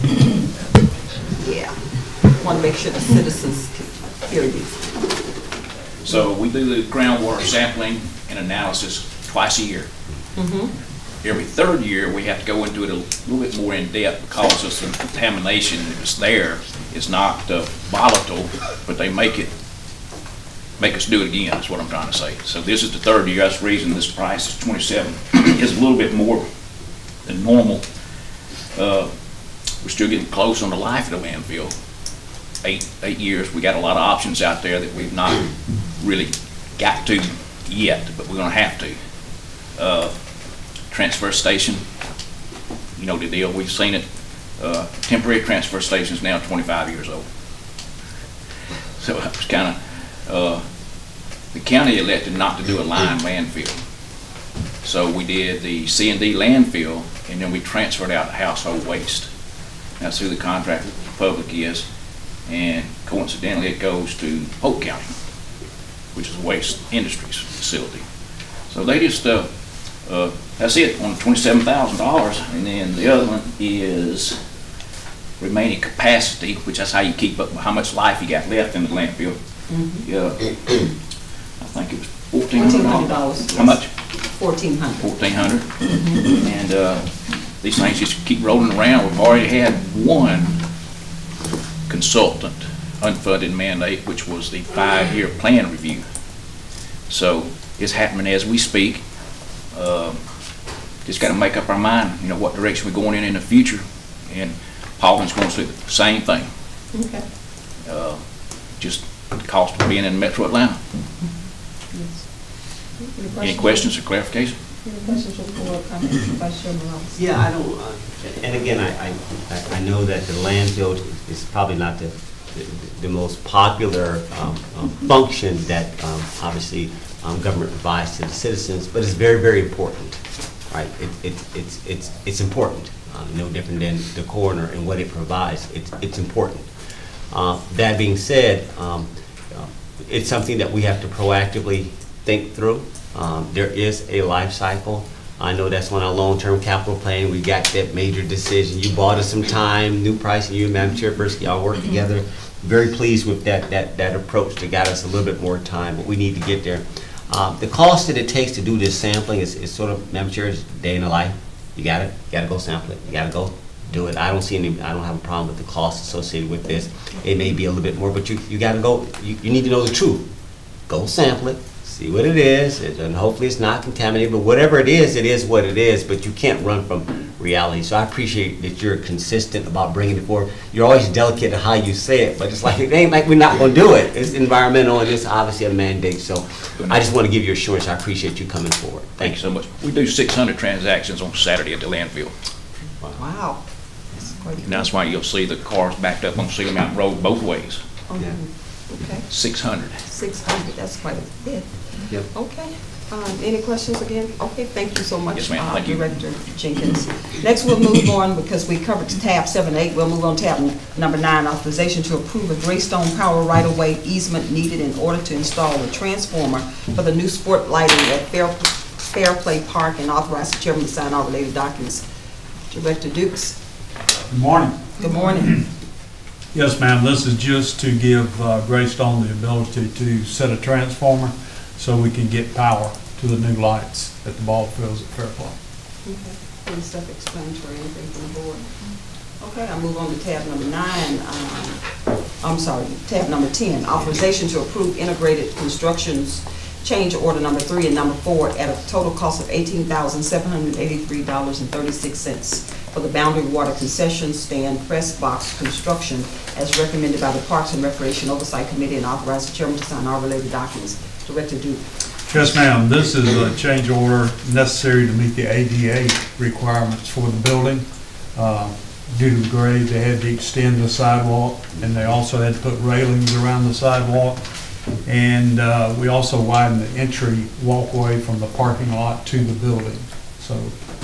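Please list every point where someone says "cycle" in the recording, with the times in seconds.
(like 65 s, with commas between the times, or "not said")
144 s.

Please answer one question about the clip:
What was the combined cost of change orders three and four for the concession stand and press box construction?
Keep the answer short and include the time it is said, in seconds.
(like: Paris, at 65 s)
$18,783.36, at 249 s.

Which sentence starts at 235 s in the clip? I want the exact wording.
Okay, any self-explanatory, anything from the board?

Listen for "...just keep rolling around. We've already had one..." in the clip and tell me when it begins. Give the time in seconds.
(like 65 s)
88 s.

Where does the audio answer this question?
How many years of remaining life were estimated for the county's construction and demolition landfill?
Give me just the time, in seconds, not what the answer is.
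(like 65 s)
32 s.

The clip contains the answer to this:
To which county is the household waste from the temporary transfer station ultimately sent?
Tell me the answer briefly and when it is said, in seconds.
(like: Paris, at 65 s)
Polk County, at 64 s.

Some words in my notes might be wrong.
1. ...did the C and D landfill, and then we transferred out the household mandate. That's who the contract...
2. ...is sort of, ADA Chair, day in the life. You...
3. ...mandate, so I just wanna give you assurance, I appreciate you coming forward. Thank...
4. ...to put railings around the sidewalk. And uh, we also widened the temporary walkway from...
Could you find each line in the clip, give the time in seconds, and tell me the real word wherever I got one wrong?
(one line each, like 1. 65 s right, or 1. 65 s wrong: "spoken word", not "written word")
1. 55 s wrong: "waste", not "mandate"
2. 159 s wrong: "Madam", not "ADA"
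3. 185 s right
4. 272 s wrong: "entry", not "temporary".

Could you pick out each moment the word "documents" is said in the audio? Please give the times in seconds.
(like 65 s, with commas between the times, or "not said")
221 s, 260 s.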